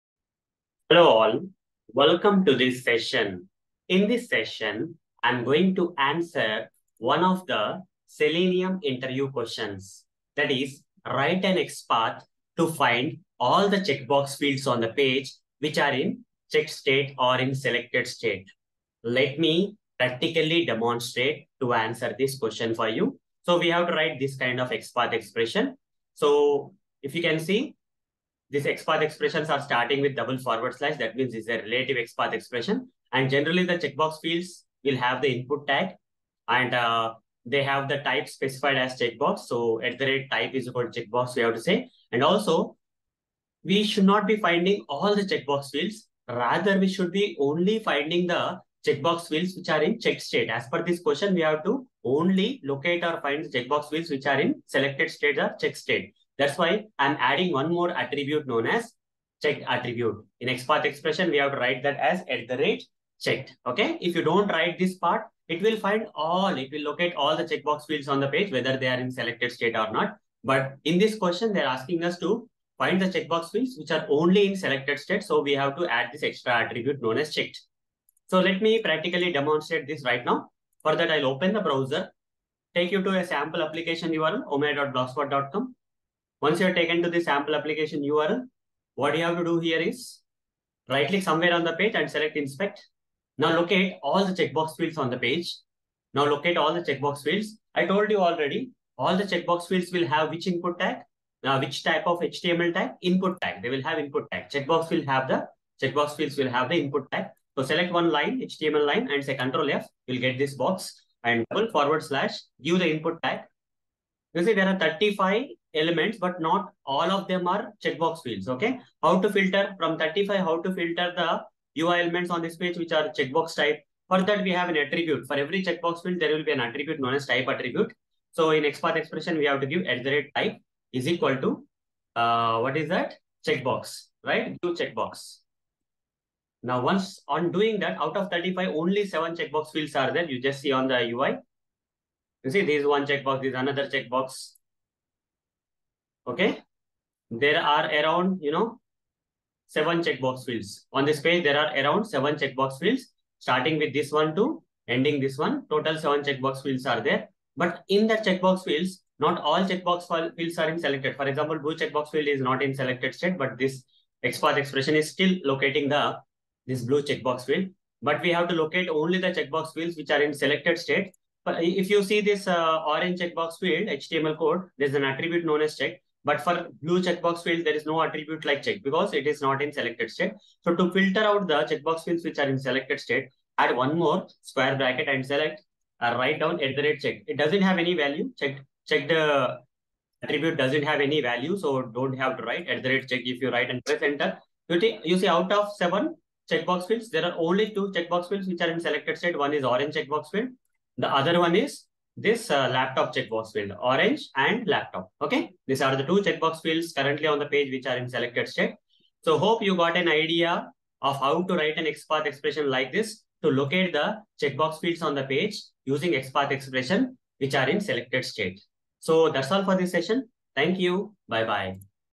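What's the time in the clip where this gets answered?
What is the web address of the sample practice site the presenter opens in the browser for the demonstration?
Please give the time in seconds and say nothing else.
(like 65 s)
84 s.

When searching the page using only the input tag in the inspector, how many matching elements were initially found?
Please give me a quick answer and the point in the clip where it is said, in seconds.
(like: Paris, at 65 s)
35, at 114 s.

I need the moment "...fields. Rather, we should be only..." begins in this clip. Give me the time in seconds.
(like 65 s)
45 s.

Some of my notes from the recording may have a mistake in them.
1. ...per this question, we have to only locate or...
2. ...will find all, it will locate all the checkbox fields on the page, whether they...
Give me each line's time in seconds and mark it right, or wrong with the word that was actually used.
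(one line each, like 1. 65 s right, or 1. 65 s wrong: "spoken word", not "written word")
1. 50 s right
2. 65 s right.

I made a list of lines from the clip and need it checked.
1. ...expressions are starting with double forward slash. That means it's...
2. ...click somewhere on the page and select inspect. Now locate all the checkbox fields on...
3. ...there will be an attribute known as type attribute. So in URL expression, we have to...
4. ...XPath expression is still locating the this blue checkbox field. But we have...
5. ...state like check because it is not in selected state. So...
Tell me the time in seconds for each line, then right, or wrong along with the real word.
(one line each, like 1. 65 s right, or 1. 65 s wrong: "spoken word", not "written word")
1. 29 s right
2. 91 s right
3. 126 s wrong: "XPath", not "URL"
4. 164 s right
5. 178 s wrong: "attribute", not "state".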